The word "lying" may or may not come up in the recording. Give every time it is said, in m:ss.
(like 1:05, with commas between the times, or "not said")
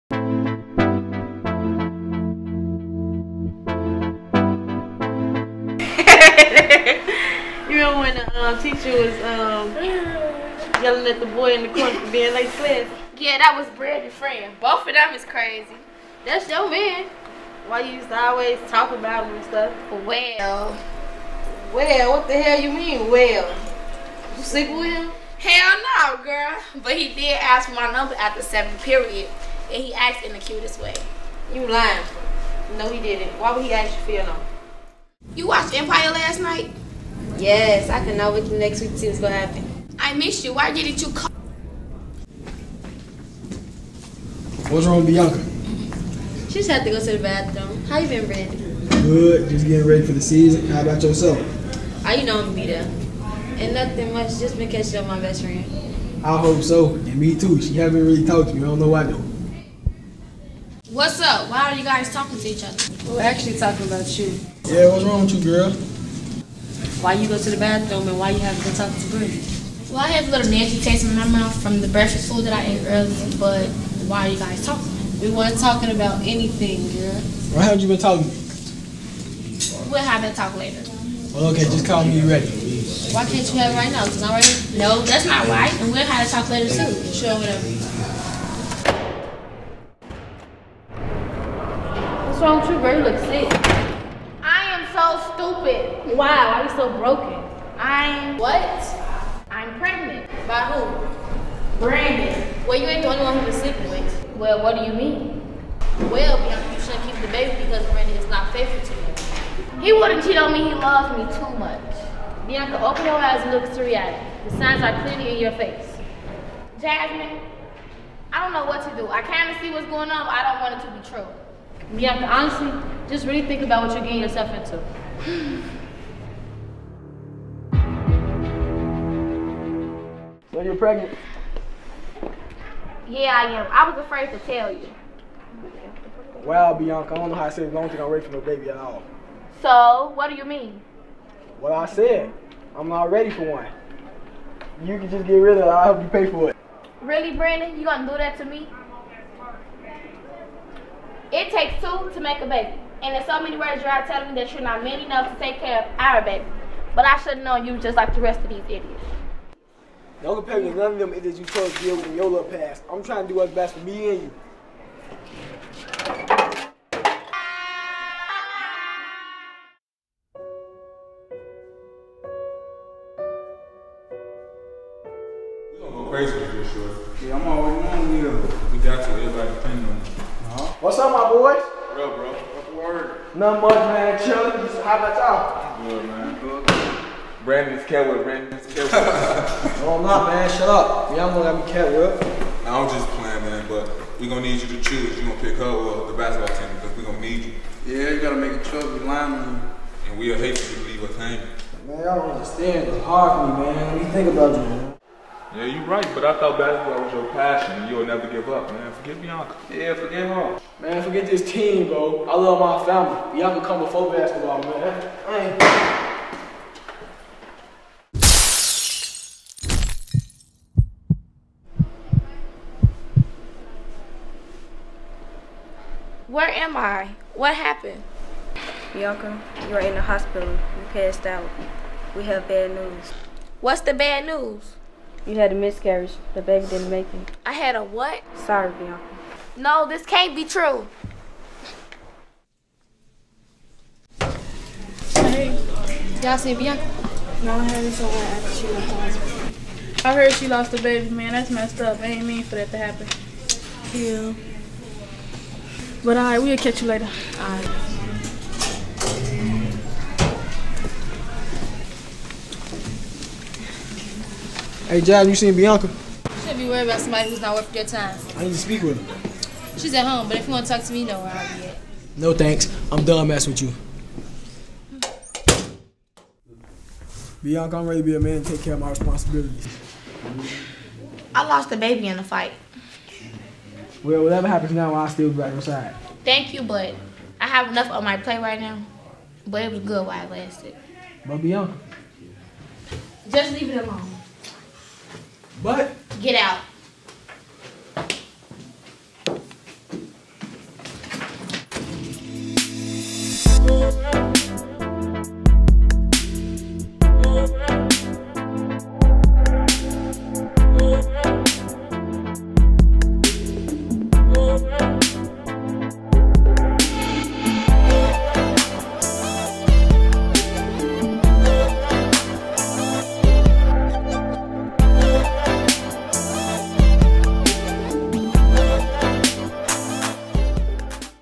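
0:31, 3:19.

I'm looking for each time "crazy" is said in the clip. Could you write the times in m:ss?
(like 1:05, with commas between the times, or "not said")
0:15, 2:56.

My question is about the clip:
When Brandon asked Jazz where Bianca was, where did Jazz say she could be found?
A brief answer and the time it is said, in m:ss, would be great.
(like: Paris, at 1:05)
At home, at 4:29.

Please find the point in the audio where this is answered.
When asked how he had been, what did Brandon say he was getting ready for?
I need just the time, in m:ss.
0:50.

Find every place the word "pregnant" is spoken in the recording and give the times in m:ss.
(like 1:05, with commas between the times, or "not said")
1:39, 2:10.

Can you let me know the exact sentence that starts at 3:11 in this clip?
Y'all gonna that me am with.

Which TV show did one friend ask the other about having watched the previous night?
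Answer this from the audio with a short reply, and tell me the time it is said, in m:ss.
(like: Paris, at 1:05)
Empire, at 0:35.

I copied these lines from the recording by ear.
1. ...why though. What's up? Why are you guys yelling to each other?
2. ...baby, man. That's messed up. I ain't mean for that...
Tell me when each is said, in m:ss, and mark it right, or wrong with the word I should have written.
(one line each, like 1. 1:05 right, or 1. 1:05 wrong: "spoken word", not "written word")
1. 0:58 wrong: "talking", not "yelling"
2. 4:10 right.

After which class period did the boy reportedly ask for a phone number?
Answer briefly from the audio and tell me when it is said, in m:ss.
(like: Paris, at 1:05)
7th period, at 0:28.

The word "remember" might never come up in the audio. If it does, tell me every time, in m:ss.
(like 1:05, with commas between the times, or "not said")
0:07.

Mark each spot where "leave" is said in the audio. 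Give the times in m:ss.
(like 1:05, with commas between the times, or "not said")
3:20, 4:53.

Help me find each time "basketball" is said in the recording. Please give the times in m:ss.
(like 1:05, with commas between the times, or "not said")
3:16, 3:26, 3:34.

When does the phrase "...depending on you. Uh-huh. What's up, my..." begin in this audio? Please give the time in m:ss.
2:59.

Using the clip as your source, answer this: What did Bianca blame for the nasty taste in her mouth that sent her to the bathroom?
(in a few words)
Breakfast food.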